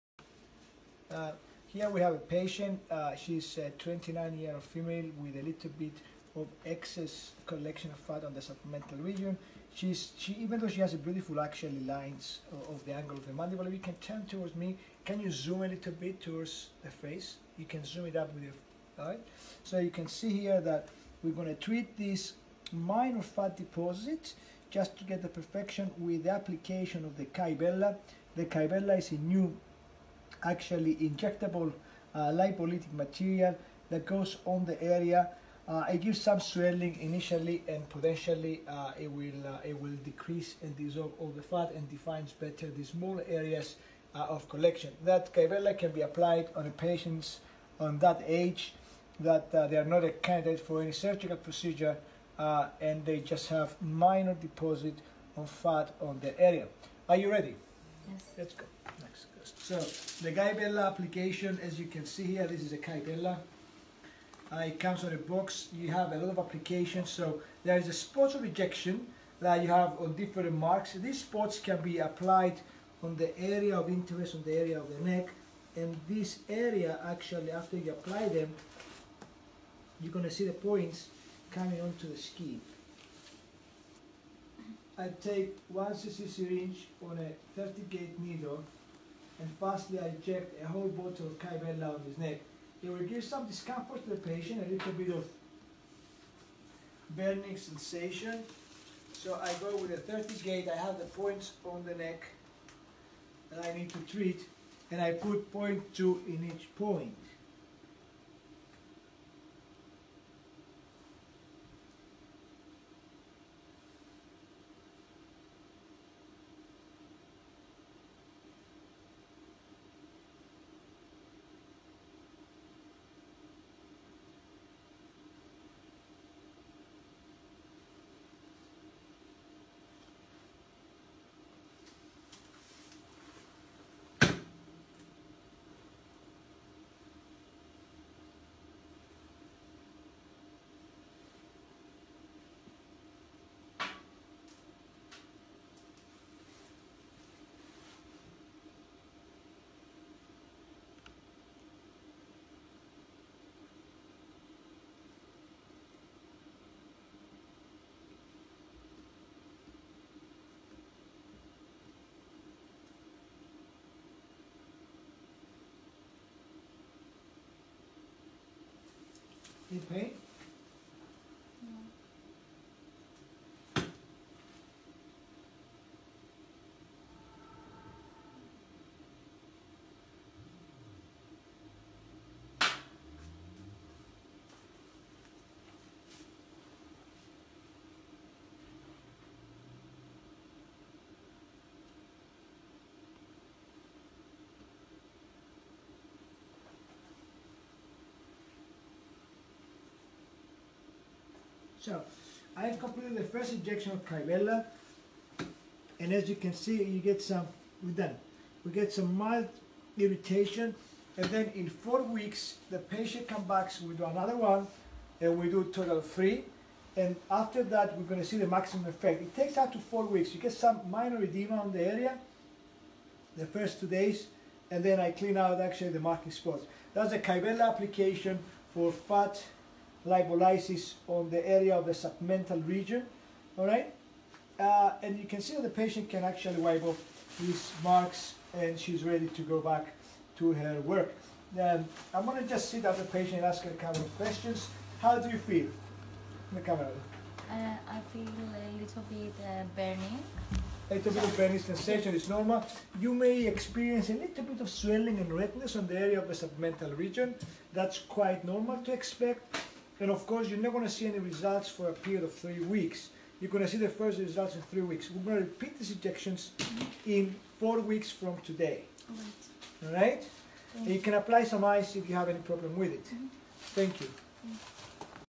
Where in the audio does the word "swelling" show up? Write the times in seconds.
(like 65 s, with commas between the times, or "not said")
36 s, 254 s.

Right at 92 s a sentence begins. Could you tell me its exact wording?
It will give some discomfort to the patient, a little bit of burning sensation.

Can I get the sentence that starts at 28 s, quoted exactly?
The Kybella is a new actually injectable uh, lipolytic material that goes on the area.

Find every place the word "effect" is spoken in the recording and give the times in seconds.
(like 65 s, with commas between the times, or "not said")
218 s.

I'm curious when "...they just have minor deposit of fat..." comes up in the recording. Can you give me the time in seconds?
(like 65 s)
53 s.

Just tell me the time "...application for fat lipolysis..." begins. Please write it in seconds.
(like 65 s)
227 s.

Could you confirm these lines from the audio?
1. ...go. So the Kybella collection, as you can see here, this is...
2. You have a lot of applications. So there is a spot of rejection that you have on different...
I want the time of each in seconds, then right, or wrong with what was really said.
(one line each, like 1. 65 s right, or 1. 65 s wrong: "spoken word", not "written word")
1. 58 s wrong: "application", not "collection"
2. 65 s right.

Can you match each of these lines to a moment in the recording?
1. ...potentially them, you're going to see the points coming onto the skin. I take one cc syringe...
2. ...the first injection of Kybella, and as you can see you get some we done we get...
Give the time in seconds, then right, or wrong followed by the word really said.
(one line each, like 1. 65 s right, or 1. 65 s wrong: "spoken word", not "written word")
1. 77 s wrong: "apply", not "potentially"
2. 203 s right.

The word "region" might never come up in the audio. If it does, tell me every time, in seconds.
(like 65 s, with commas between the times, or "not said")
9 s, 232 s, 256 s.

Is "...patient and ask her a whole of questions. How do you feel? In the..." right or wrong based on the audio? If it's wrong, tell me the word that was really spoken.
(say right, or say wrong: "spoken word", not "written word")
wrong: "couple", not "whole".